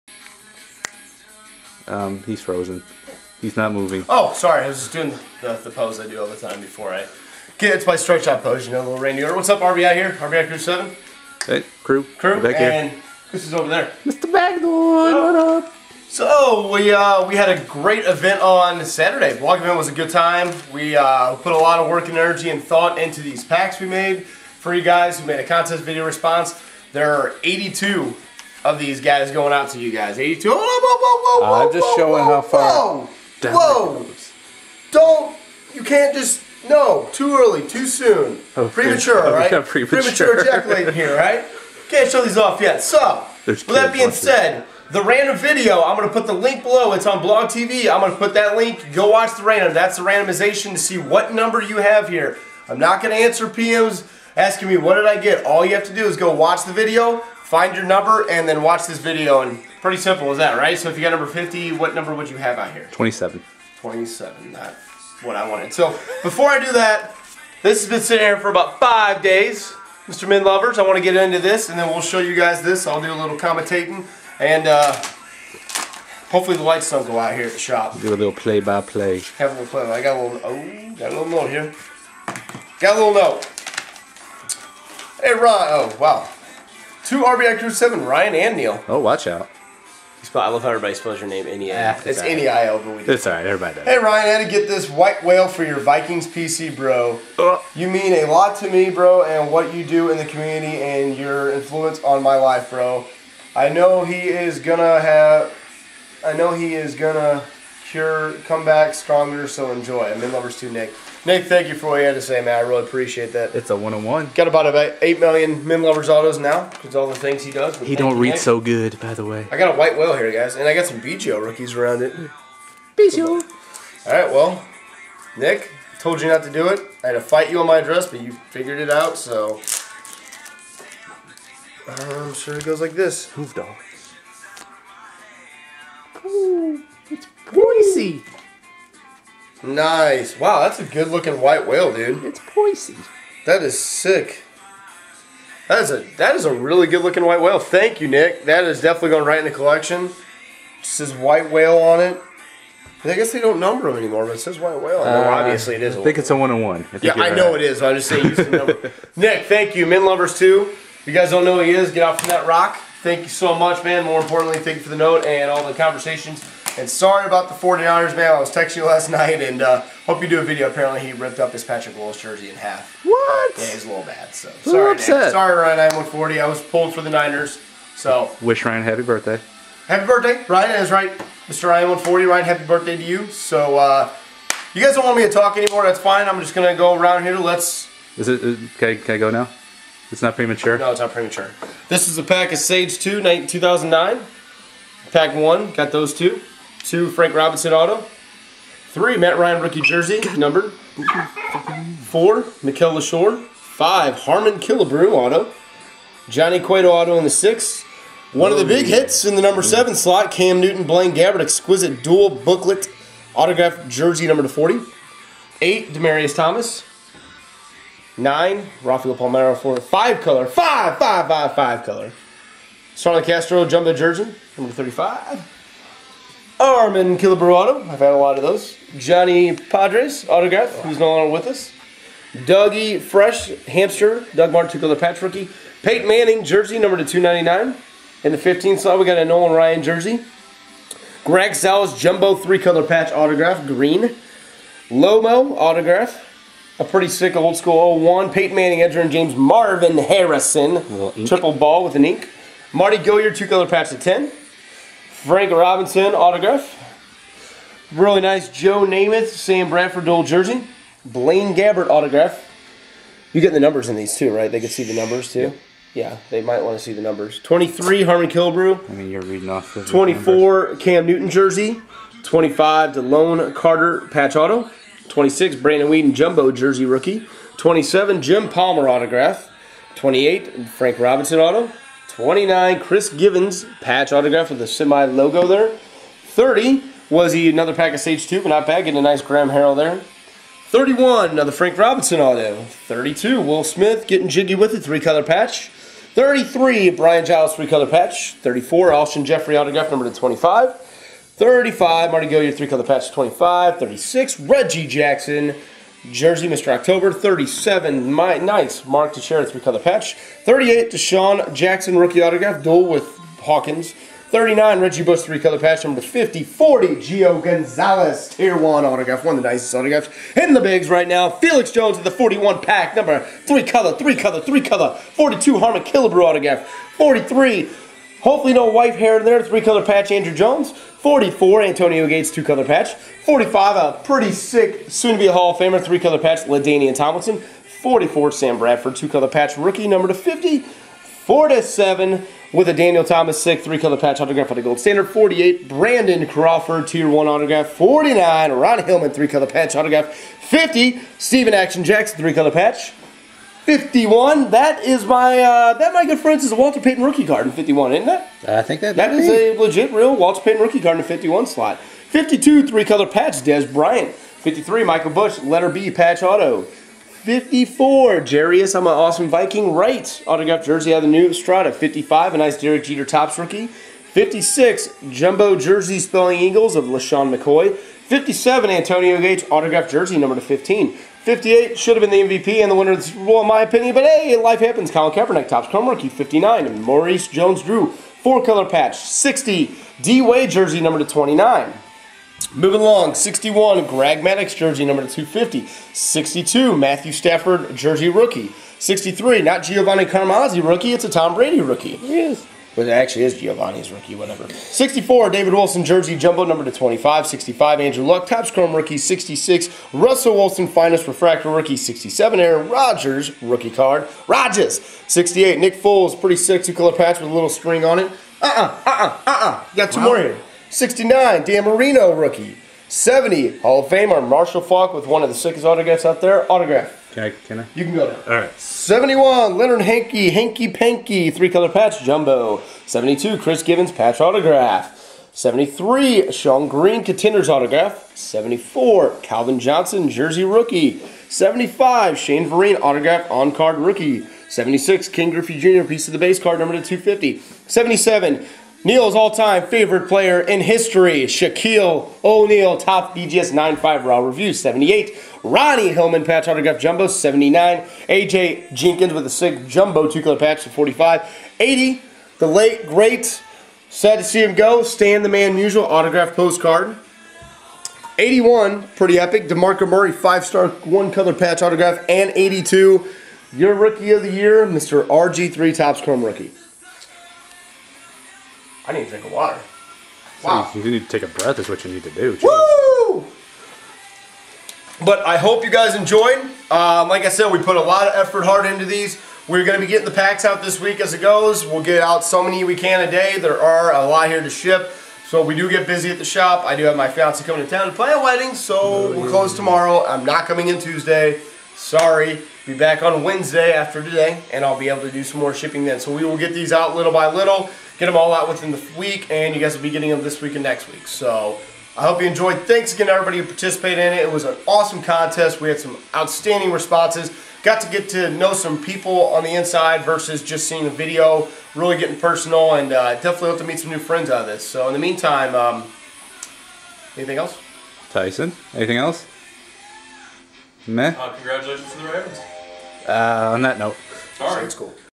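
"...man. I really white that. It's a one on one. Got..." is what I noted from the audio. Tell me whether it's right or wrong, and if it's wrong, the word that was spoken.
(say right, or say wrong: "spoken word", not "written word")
wrong: "appreciate", not "white".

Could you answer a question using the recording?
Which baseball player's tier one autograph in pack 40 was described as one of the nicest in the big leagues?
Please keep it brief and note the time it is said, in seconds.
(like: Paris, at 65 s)
Gio Gonzalez, at 316 s.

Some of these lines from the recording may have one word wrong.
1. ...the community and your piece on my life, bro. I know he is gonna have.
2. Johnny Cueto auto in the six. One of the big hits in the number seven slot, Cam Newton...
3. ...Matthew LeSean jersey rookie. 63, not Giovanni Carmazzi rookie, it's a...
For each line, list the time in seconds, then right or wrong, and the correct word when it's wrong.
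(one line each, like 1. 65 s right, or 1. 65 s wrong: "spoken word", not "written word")
1. 100 s wrong: "influence", not "piece"
2. 206 s right
3. 396 s wrong: "Stafford", not "LeSean".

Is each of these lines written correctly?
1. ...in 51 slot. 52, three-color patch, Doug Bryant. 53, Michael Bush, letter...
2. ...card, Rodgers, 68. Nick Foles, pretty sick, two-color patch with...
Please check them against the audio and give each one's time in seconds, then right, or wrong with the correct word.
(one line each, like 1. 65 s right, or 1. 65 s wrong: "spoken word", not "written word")
1. 360 s wrong: "Dez", not "Doug"
2. 413 s right.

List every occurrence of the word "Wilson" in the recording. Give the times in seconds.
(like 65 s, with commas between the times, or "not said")
405 s, 410 s.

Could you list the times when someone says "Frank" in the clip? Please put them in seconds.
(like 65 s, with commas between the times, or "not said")
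197 s, 255 s, 280 s, 291 s.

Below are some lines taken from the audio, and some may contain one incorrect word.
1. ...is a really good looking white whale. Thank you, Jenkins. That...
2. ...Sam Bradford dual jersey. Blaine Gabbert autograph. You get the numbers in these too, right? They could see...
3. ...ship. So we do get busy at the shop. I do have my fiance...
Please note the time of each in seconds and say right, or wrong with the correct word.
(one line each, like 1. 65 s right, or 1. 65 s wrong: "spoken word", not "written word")
1. 146 s wrong: "Nick", not "Jenkins"
2. 259 s right
3. 494 s right.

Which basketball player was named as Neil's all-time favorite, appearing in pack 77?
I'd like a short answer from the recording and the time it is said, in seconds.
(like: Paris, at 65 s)
Shaquille O'Neal, at 451 s.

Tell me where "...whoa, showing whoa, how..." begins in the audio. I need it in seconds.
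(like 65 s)
31 s.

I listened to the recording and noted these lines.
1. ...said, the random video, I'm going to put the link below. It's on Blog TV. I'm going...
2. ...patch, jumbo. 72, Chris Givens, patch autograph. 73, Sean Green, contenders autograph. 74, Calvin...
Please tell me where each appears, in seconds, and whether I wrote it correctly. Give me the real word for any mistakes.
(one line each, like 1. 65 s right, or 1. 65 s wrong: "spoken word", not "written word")
1. 44 s right
2. 431 s right.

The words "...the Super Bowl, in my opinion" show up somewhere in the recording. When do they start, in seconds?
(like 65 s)
382 s.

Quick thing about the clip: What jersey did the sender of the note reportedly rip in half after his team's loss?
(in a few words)
Patrick Willis jersey.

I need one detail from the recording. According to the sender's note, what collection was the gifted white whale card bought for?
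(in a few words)
Vikings PC.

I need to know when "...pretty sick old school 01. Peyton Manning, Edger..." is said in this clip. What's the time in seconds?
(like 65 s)
246 s.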